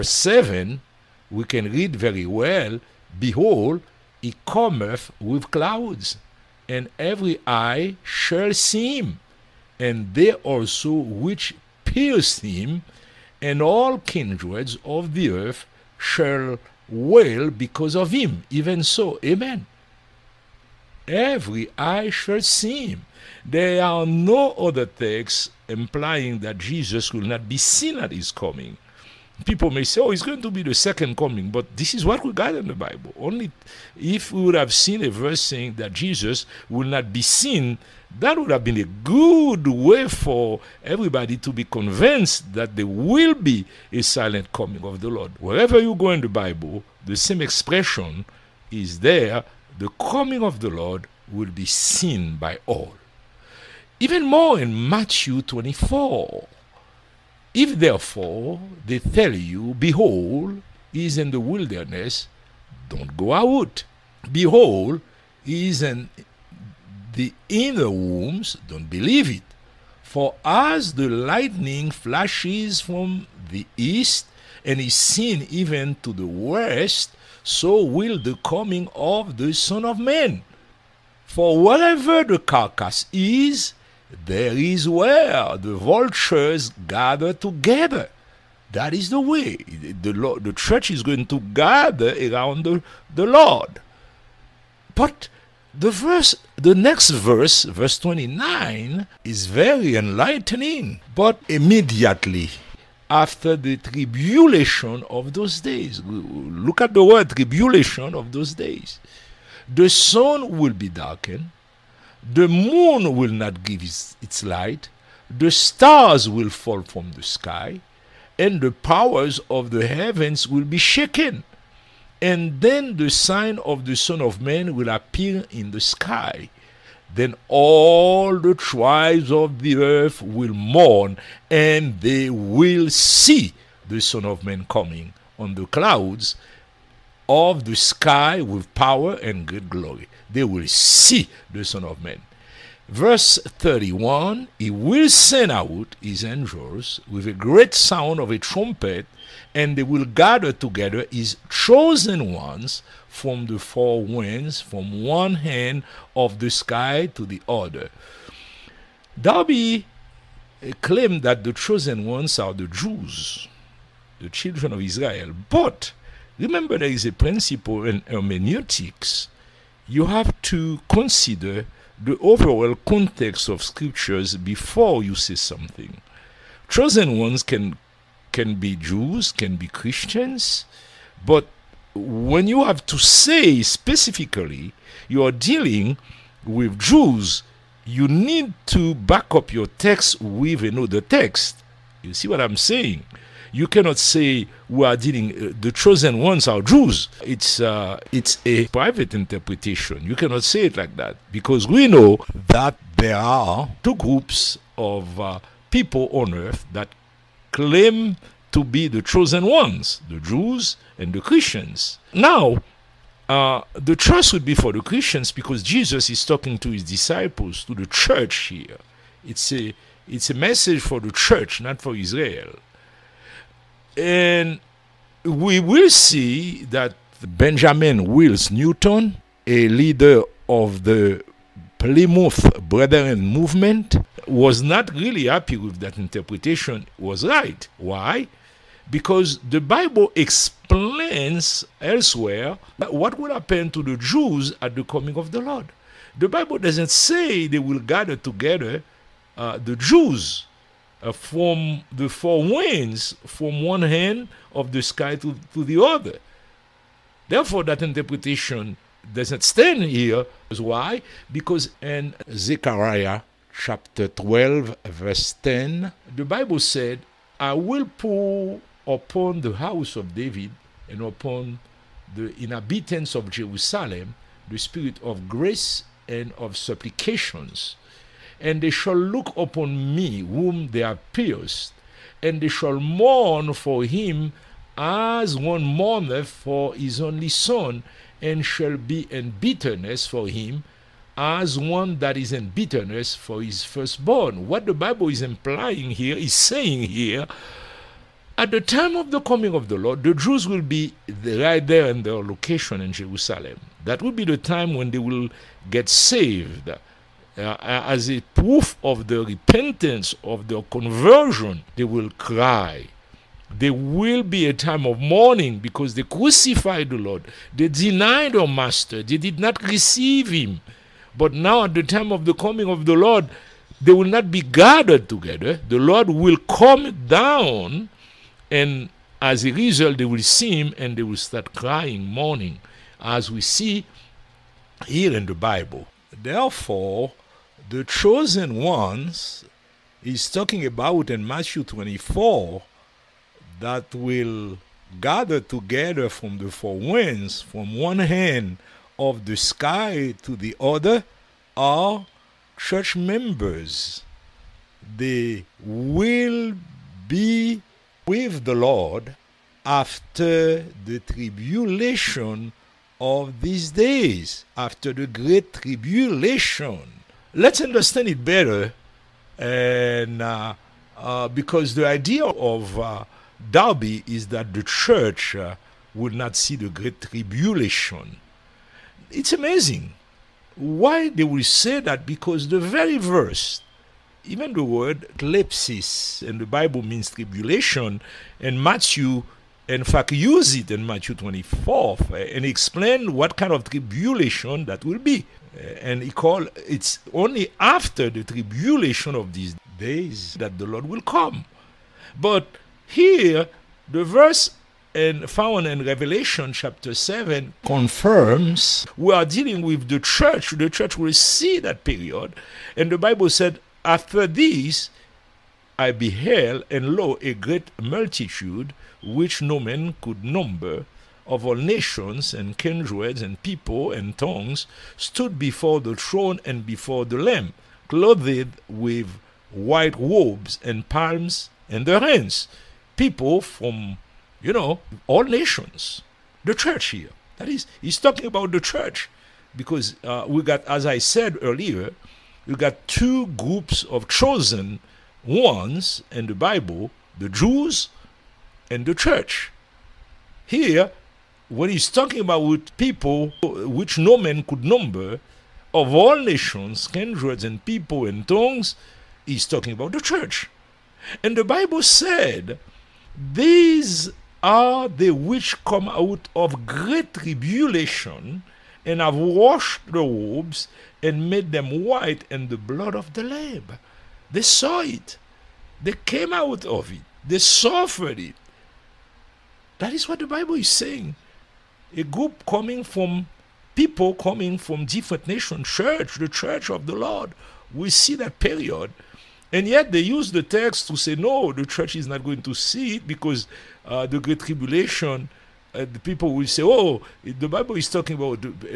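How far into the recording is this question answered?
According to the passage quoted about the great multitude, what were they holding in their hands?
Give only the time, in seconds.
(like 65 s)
430 s.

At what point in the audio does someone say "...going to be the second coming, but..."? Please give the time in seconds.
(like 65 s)
30 s.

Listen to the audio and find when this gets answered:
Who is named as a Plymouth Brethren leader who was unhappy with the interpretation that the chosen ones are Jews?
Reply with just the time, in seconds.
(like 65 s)
227 s.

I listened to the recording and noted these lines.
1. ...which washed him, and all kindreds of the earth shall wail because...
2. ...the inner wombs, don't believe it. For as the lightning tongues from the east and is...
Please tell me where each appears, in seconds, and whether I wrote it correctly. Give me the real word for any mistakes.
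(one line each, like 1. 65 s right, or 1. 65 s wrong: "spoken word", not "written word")
1. 10 s wrong: "pierced", not "washed"
2. 67 s wrong: "flashes", not "tongues".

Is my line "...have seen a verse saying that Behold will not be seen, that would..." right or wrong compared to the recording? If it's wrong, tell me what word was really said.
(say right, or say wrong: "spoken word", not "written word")
wrong: "Jesus", not "Behold".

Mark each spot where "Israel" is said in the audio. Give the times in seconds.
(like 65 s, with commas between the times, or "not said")
164 s, 221 s.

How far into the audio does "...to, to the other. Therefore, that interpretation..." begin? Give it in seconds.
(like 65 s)
255 s.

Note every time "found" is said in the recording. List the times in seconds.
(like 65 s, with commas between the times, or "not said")
405 s.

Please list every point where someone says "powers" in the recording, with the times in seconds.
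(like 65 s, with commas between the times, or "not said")
118 s, 138 s.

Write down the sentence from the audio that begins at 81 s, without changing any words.
For wherever the carcass is, there is where the vultures gather together.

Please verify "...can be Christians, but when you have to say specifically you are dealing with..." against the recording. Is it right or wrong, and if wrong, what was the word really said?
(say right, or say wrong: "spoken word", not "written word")
right.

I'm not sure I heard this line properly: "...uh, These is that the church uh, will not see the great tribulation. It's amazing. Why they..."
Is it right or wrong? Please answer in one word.
wrong.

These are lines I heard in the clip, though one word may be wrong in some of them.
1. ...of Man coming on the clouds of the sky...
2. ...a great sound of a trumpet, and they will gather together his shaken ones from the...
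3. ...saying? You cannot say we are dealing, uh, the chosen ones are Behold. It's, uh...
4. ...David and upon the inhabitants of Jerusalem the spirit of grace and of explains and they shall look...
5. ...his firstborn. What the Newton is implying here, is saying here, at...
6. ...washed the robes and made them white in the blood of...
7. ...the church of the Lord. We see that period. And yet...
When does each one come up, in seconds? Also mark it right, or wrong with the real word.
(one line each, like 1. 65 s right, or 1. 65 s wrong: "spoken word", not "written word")
1. 134 s right
2. 147 s wrong: "chosen", not "shaken"
3. 192 s wrong: "Jews", not "Behold"
4. 270 s wrong: "supplications", not "explains"
5. 293 s wrong: "Bible", not "Newton"
6. 469 s right
7. 486 s right.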